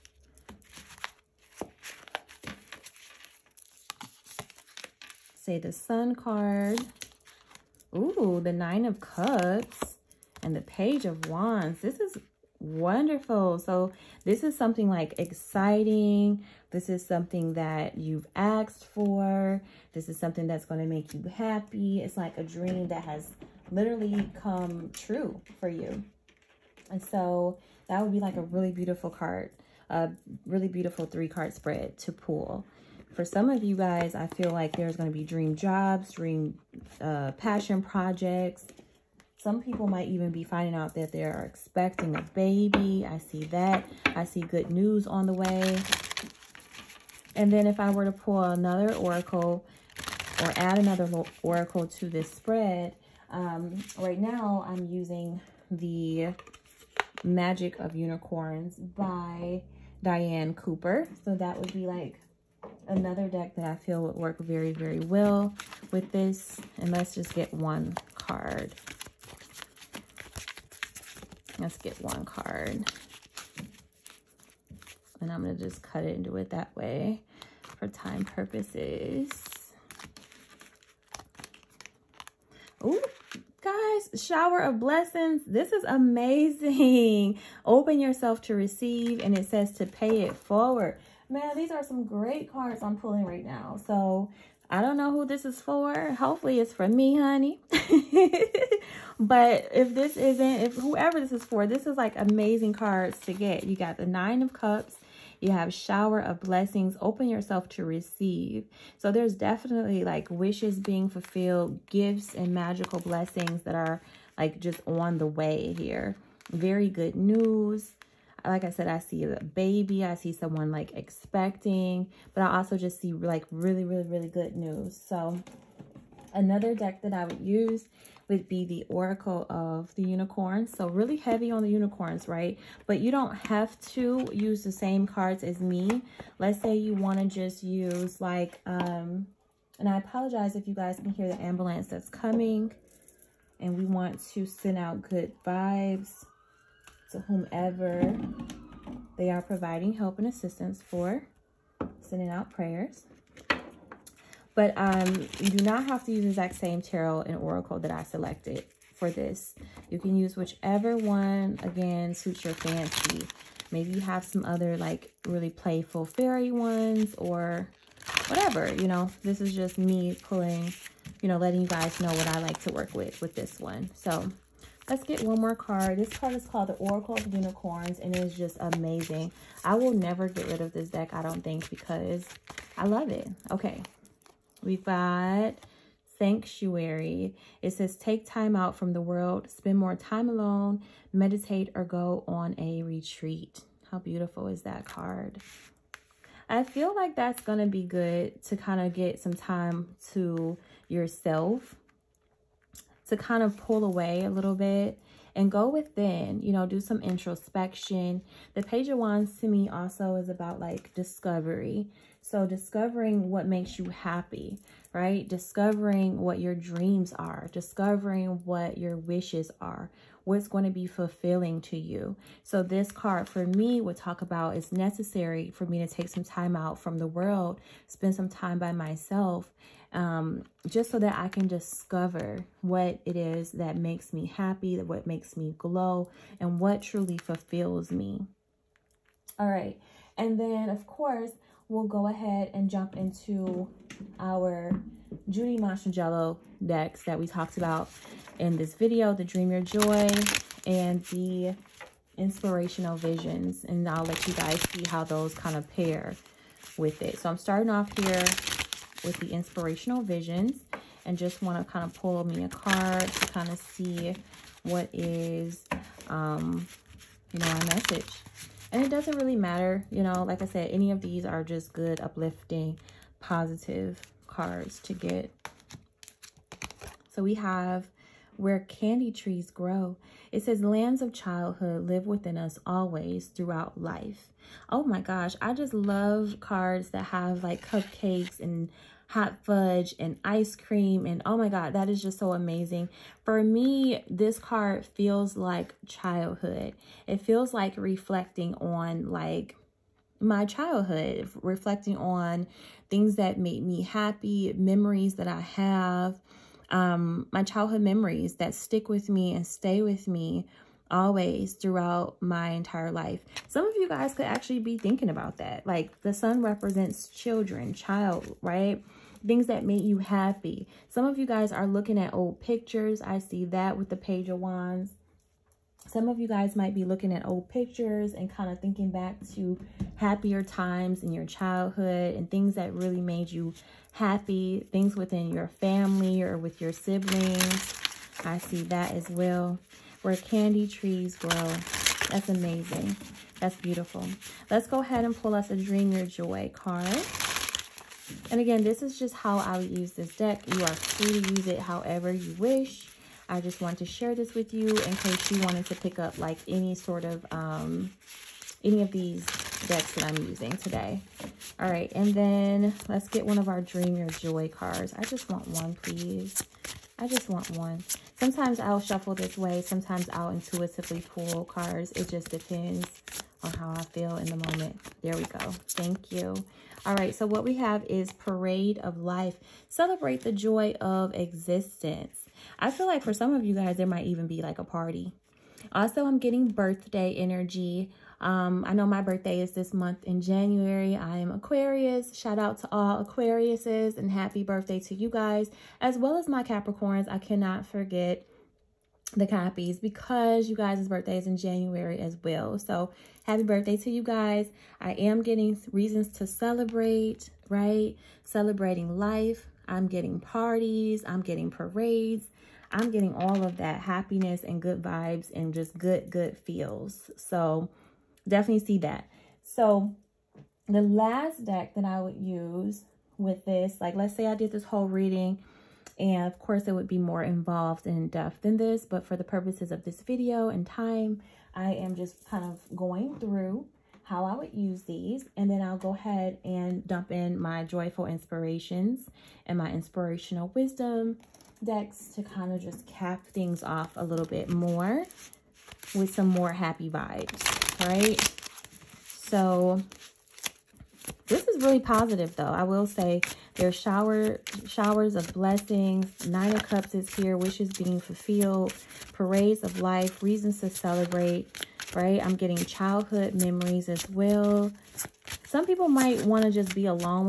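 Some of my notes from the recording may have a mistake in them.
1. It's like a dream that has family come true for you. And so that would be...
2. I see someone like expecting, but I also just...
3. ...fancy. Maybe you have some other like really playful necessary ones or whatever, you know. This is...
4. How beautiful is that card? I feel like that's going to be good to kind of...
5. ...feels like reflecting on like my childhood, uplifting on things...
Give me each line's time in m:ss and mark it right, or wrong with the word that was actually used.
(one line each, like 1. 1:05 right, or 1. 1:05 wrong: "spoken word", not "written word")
1. 0:22 wrong: "literally", not "family"
2. 2:00 right
3. 2:42 wrong: "fairy", not "necessary"
4. 3:13 right
5. 4:57 wrong: "reflecting", not "uplifting".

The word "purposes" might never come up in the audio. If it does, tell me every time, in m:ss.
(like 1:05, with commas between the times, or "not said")
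1:18, 7:09.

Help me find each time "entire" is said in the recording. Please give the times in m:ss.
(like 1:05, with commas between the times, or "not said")
5:12.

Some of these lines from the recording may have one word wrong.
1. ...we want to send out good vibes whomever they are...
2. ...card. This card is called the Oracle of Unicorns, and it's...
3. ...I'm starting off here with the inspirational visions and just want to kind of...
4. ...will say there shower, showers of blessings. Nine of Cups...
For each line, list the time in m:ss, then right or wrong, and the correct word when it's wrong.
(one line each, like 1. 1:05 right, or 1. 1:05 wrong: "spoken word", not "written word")
1. 2:23 right
2. 2:55 right
3. 4:17 right
4. 7:32 right.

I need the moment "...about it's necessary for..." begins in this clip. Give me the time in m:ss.
3:44.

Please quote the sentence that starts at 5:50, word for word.
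You are free to use it however you wish.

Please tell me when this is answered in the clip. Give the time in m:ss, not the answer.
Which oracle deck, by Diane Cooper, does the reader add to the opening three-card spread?
0:57.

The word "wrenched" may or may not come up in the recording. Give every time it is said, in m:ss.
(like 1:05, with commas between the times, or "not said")
not said.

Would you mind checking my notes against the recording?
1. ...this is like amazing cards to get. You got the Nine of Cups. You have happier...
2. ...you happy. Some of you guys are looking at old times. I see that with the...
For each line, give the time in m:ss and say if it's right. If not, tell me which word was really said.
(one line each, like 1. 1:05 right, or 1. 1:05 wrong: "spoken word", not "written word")
1. 1:41 wrong: "shower", not "happier"
2. 5:19 wrong: "pictures", not "times".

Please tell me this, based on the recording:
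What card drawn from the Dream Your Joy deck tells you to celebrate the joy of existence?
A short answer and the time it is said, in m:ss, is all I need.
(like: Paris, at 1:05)
Parade of Life, at 6:18.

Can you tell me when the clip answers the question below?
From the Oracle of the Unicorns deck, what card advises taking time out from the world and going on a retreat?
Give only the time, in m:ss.
3:06.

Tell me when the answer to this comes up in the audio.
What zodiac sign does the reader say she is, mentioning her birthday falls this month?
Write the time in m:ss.
6:31.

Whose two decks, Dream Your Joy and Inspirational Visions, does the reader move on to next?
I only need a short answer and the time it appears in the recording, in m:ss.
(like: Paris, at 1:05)
Judy Mastrangelo, at 4:05.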